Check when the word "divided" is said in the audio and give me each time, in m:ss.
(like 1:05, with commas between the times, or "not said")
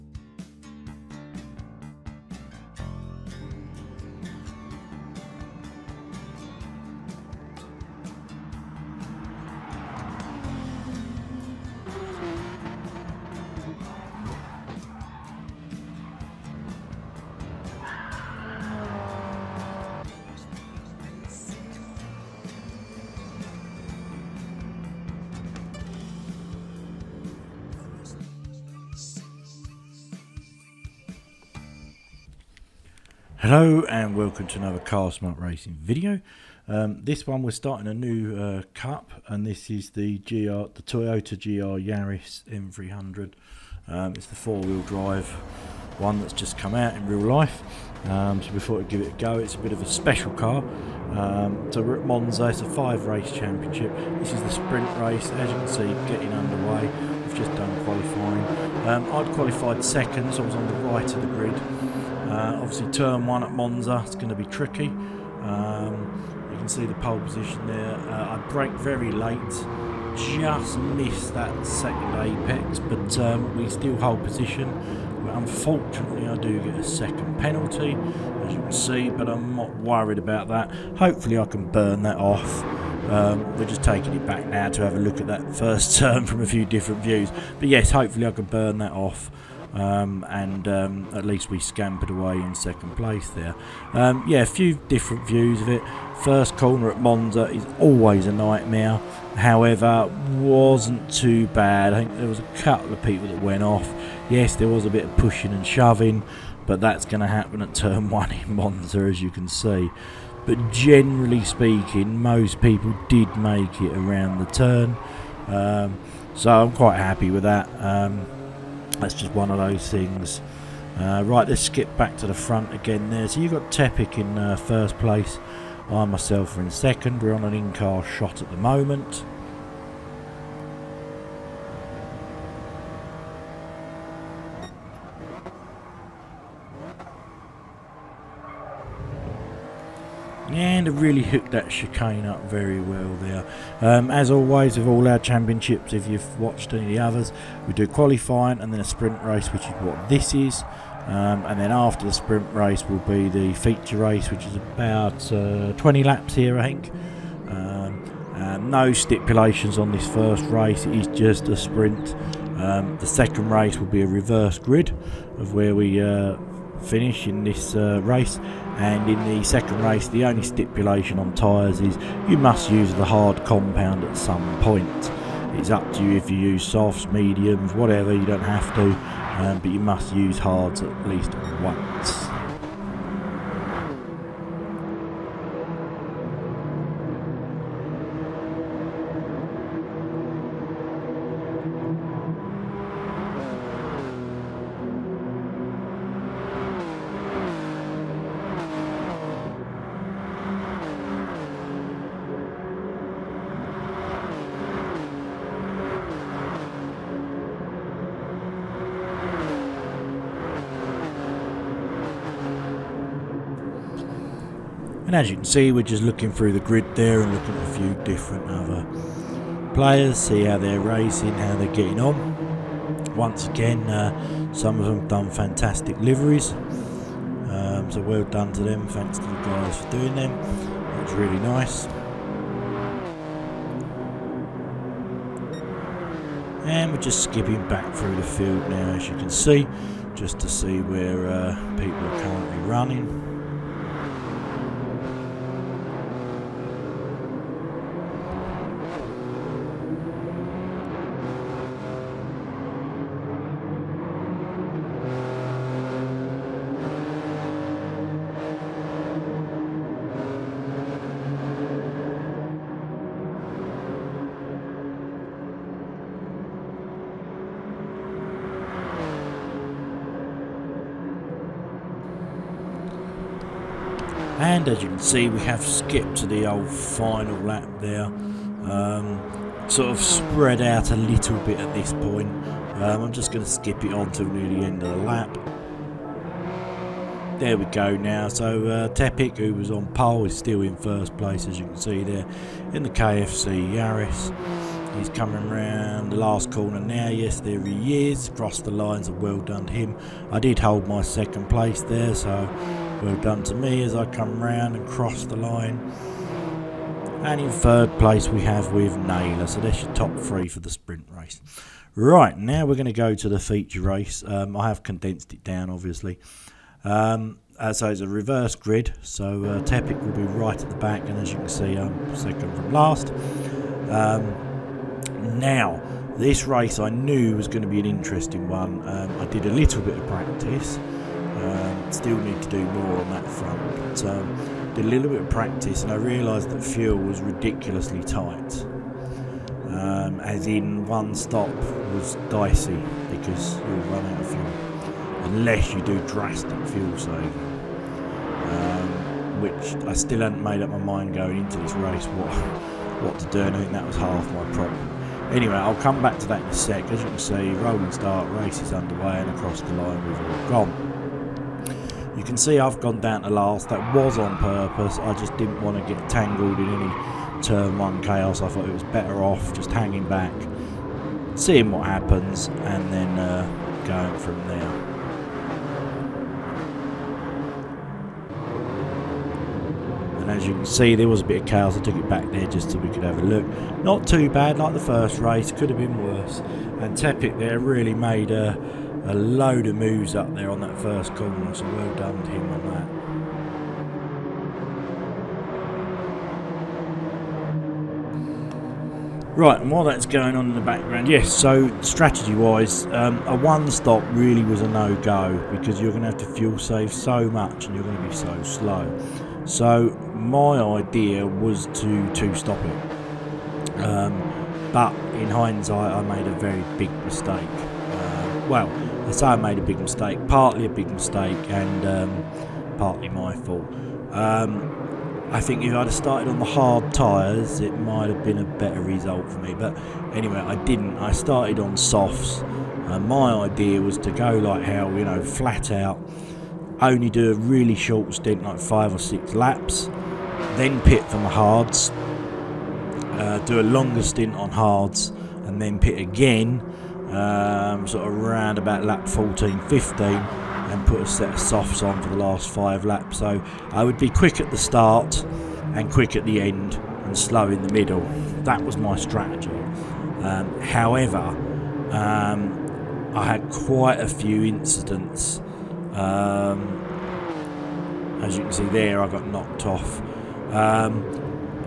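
not said.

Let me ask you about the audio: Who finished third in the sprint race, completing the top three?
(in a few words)
Naylor.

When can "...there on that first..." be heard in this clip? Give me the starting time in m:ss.
6:30.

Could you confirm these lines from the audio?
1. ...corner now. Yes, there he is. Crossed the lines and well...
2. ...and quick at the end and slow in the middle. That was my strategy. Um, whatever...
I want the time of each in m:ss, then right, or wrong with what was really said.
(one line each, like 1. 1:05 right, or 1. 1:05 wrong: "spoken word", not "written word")
1. 4:56 right
2. 7:35 wrong: "however", not "whatever".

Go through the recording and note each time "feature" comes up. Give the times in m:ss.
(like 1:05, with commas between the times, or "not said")
2:33, 5:13.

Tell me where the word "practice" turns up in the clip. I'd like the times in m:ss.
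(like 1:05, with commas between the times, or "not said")
5:30, 5:35.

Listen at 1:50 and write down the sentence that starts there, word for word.
But generally speaking, most people did make it around the turn.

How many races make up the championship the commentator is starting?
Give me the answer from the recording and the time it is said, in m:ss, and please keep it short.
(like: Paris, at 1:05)
5, at 0:52.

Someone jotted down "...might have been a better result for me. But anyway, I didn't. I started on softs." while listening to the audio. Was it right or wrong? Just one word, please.
right.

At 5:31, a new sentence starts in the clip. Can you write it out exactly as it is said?
Um, still need to do more on that front.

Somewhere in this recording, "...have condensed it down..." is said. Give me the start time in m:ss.
5:14.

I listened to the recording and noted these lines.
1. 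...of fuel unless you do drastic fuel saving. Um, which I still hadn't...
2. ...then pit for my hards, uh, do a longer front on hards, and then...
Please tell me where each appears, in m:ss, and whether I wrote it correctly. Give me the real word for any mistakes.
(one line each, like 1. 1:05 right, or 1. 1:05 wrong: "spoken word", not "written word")
1. 5:44 right
2. 7:20 wrong: "stint", not "front".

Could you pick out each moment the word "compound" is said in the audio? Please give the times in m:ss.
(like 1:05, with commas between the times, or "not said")
2:53.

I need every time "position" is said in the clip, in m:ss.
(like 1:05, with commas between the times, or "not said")
1:07, 1:14.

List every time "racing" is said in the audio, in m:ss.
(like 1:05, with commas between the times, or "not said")
0:35, 3:40.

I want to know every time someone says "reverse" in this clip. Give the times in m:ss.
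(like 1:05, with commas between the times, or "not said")
2:44, 5:18.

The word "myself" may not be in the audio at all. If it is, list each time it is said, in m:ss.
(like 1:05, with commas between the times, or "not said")
2:06.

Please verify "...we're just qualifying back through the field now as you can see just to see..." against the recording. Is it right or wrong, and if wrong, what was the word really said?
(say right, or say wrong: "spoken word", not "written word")
wrong: "skipping", not "qualifying".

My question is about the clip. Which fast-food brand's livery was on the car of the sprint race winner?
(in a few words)
KFC.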